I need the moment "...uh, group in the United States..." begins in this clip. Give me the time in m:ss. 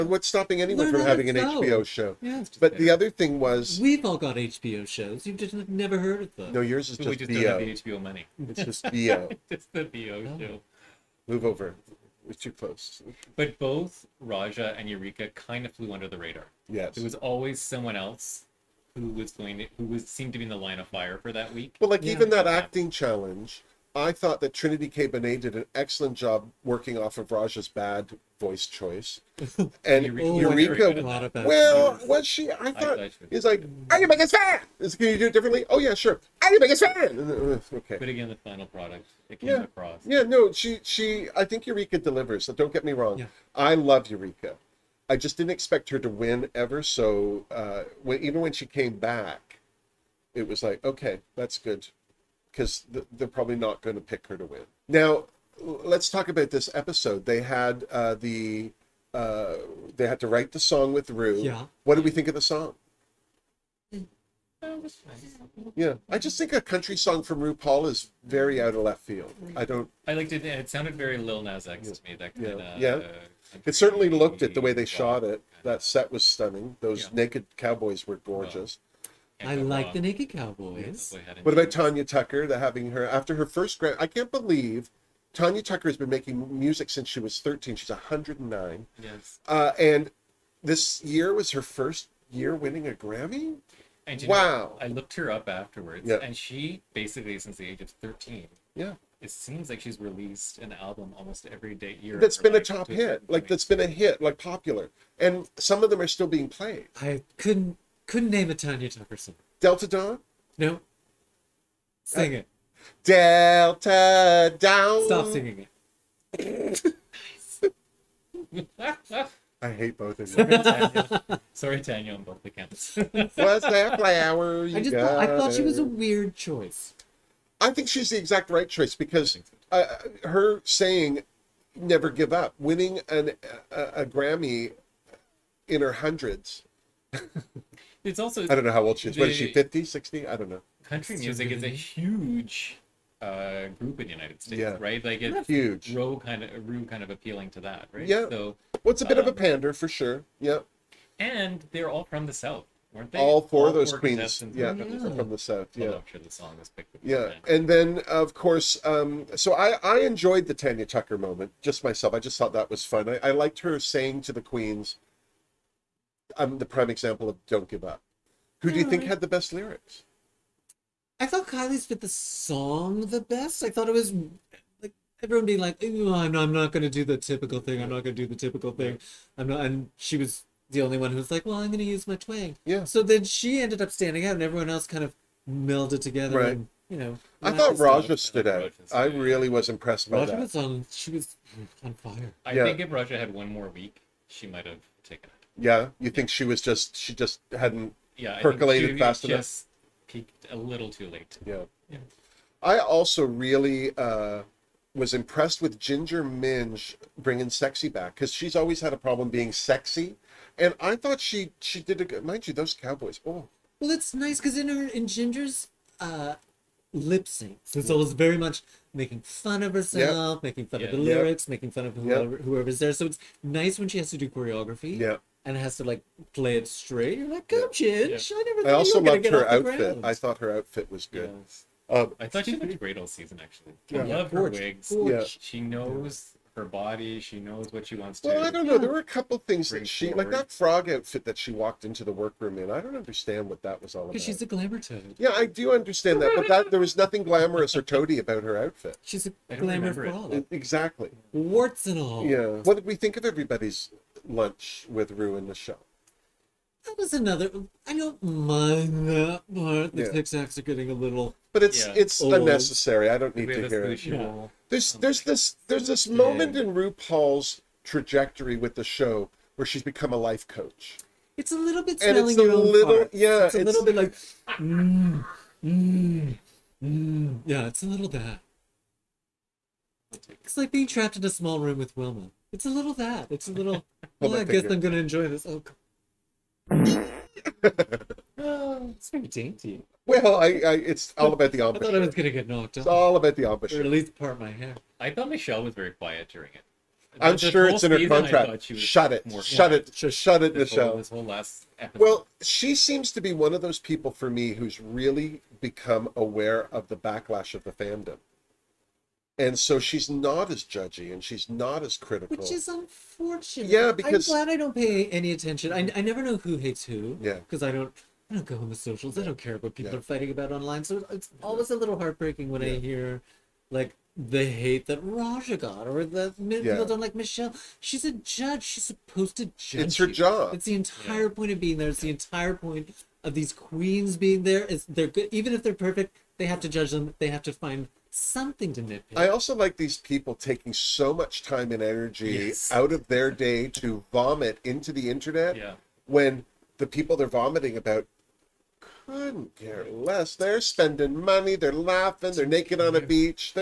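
2:23.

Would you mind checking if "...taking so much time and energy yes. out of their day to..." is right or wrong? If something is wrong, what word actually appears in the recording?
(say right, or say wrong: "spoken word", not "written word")
right.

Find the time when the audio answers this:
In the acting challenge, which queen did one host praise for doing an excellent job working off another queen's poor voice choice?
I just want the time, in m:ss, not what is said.
0:24.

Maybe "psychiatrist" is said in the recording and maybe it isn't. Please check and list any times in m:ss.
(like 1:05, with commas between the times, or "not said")
not said.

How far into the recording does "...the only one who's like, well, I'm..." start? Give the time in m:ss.
3:00.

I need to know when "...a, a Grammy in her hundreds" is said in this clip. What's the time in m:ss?
2:13.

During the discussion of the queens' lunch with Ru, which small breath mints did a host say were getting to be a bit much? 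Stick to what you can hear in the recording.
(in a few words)
Tic Tacs.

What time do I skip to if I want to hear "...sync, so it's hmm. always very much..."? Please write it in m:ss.
3:37.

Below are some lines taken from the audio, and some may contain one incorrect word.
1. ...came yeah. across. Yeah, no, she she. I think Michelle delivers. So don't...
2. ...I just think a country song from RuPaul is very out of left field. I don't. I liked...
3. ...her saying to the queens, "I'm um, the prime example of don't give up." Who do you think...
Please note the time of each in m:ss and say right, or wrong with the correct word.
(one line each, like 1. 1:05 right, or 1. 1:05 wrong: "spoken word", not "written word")
1. 0:39 wrong: "Eureka", not "Michelle"
2. 1:06 right
3. 2:43 right.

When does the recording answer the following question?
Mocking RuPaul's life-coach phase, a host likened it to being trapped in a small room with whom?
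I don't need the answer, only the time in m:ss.
4:41.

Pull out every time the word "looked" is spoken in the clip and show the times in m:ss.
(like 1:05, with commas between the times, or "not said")
1:14, 1:34, 3:52.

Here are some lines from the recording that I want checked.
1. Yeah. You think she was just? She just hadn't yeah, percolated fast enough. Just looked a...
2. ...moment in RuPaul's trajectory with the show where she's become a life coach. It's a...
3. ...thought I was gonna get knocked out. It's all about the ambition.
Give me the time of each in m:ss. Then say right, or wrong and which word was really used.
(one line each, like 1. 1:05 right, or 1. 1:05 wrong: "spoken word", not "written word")
1. 3:15 wrong: "peaked", not "looked"
2. 4:26 right
3. 4:51 right.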